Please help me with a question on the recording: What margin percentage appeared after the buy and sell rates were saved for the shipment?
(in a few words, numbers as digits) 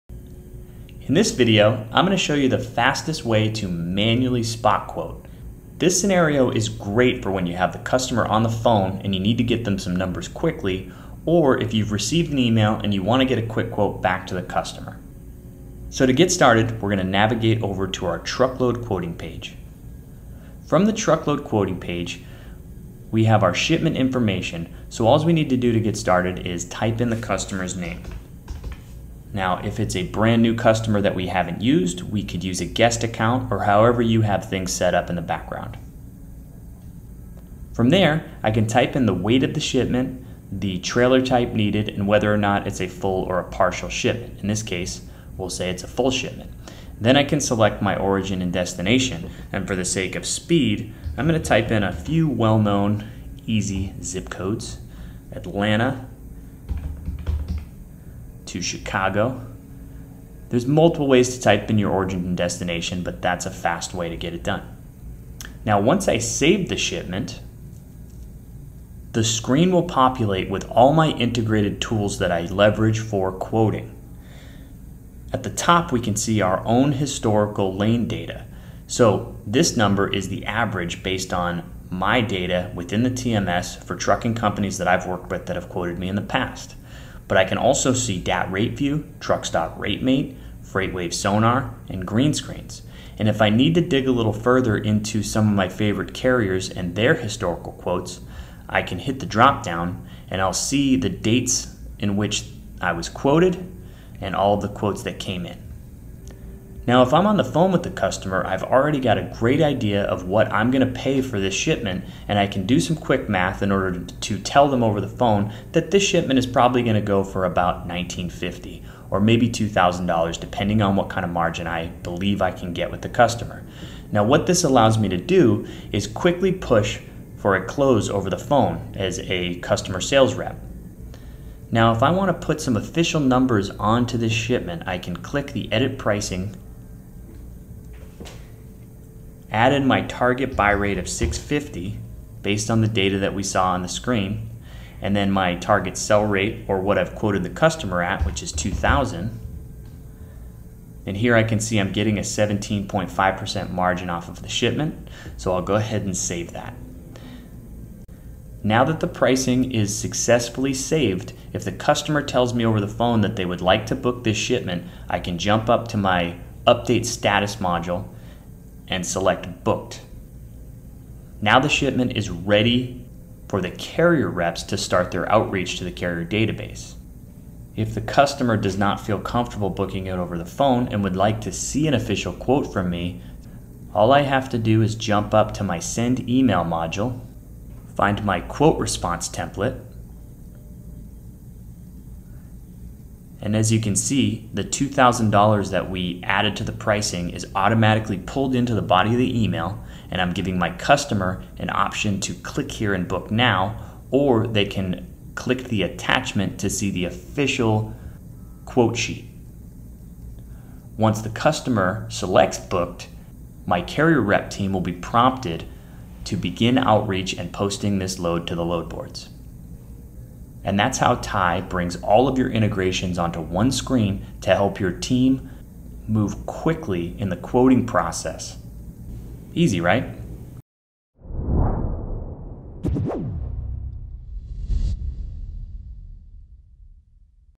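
17.5%.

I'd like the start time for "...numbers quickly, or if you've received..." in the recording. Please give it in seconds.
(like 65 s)
9 s.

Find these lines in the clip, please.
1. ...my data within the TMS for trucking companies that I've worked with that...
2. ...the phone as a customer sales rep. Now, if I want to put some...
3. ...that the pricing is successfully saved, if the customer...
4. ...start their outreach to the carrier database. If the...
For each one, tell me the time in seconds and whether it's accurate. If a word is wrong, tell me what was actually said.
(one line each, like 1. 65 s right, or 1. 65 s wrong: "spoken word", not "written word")
1. 81 s right
2. 128 s right
3. 158 s right
4. 174 s right.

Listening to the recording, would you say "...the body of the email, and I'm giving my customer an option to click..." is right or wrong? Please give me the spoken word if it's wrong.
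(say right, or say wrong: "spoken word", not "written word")
right.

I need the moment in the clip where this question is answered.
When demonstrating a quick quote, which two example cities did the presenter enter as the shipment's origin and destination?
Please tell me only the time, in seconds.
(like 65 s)
55 s.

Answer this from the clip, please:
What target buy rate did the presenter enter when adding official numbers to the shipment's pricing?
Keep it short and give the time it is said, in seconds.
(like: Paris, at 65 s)
650, at 141 s.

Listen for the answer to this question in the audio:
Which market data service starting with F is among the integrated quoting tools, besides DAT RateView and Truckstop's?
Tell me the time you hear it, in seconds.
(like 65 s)
90 s.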